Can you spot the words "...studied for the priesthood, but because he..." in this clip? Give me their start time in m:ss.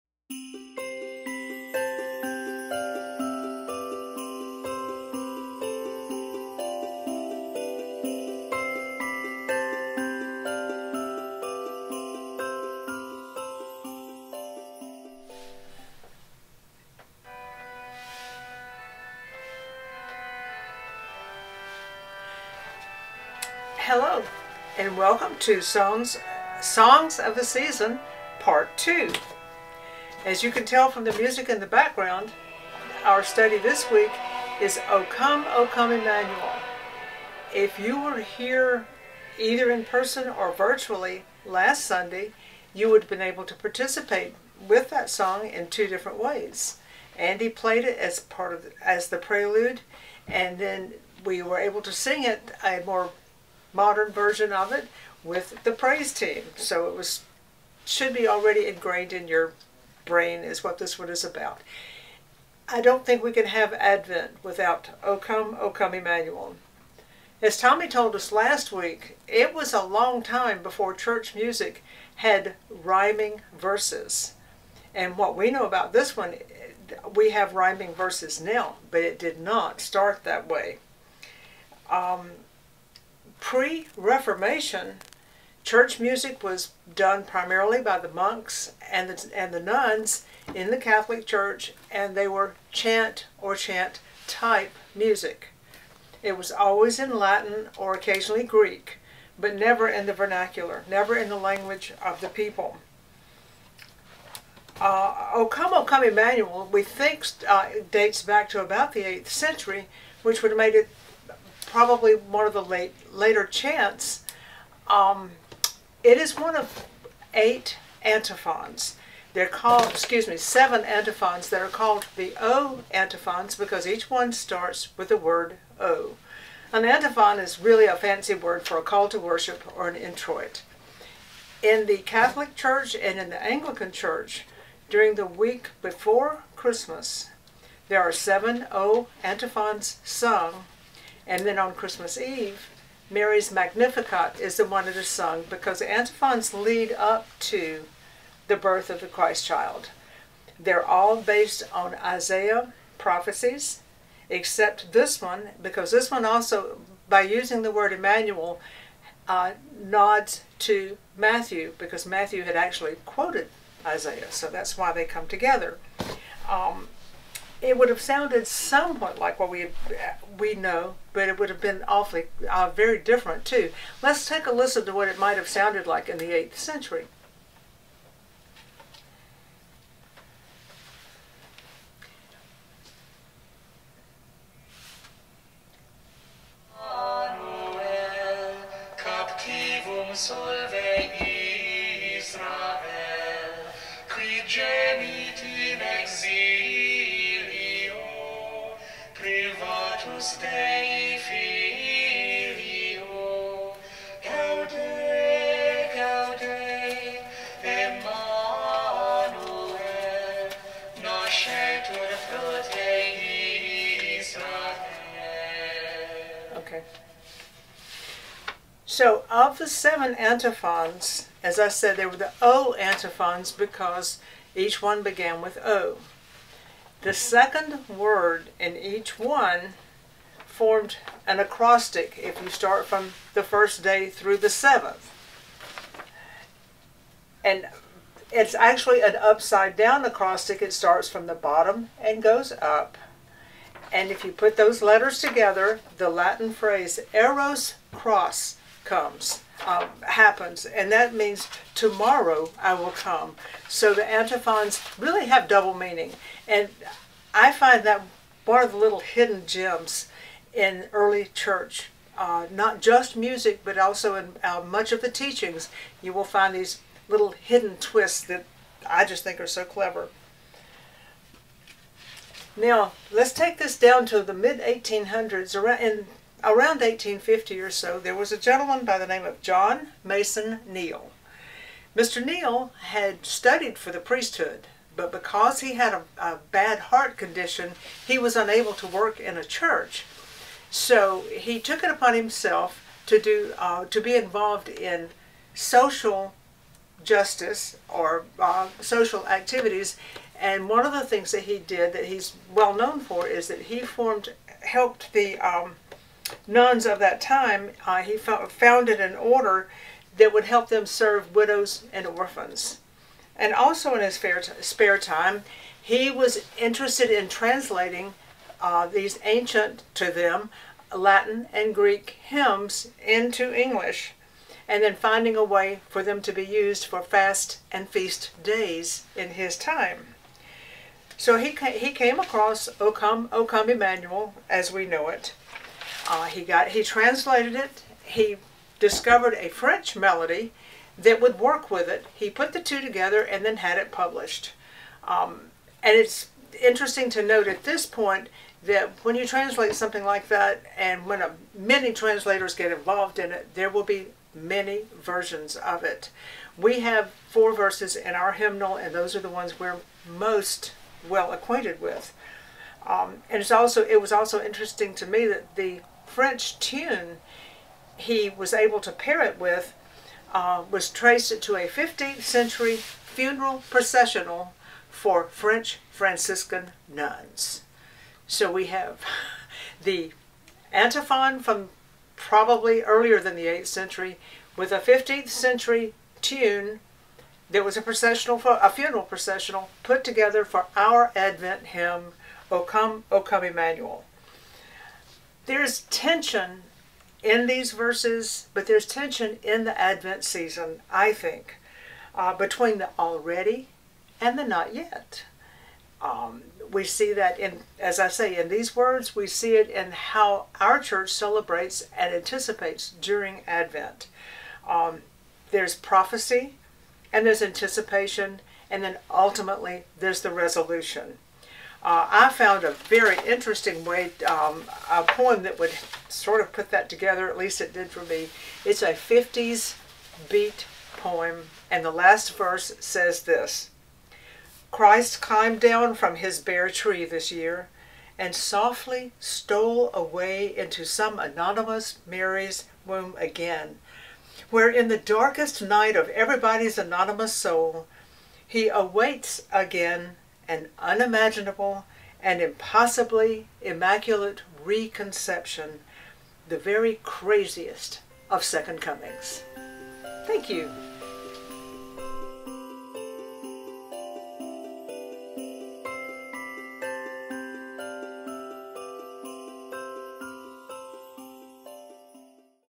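4:43.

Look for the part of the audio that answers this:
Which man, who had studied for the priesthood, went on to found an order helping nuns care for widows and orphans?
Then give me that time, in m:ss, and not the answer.
4:39.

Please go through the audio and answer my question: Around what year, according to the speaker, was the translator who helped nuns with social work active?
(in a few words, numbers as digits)
1850.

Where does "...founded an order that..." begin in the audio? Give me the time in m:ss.
5:08.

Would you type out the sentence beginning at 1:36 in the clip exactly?
It was always in Latin or occasionally Greek, but never in the vernacular, never in the language of the people.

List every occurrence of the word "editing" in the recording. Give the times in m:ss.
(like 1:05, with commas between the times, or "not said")
not said.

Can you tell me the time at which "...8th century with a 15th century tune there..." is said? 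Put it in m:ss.
6:23.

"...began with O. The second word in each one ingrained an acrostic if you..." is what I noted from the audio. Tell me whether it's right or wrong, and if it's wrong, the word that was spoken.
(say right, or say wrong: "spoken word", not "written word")
wrong: "formed", not "ingrained".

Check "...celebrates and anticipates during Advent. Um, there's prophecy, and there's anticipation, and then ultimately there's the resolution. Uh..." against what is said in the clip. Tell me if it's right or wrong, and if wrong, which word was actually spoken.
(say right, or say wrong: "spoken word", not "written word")
right.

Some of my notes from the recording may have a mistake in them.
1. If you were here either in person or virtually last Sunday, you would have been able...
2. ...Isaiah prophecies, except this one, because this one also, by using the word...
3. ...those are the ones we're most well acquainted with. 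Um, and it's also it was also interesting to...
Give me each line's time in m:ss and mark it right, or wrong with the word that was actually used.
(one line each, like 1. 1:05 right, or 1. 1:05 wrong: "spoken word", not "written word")
1. 0:37 right
2. 2:31 right
3. 5:58 right.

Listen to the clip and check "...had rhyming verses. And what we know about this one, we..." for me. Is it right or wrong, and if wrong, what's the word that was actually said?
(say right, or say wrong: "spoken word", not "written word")
right.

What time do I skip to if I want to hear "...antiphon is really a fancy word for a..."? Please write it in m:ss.
2:06.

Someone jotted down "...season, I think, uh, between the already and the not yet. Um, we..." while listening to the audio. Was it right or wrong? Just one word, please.
right.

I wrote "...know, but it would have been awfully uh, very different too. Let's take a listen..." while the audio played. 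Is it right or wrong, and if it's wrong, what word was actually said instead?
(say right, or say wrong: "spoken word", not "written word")
right.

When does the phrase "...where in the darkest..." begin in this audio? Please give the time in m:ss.
7:24.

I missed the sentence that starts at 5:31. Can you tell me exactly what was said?
So he, he came across O Come, O Come Emmanuel, as we know it.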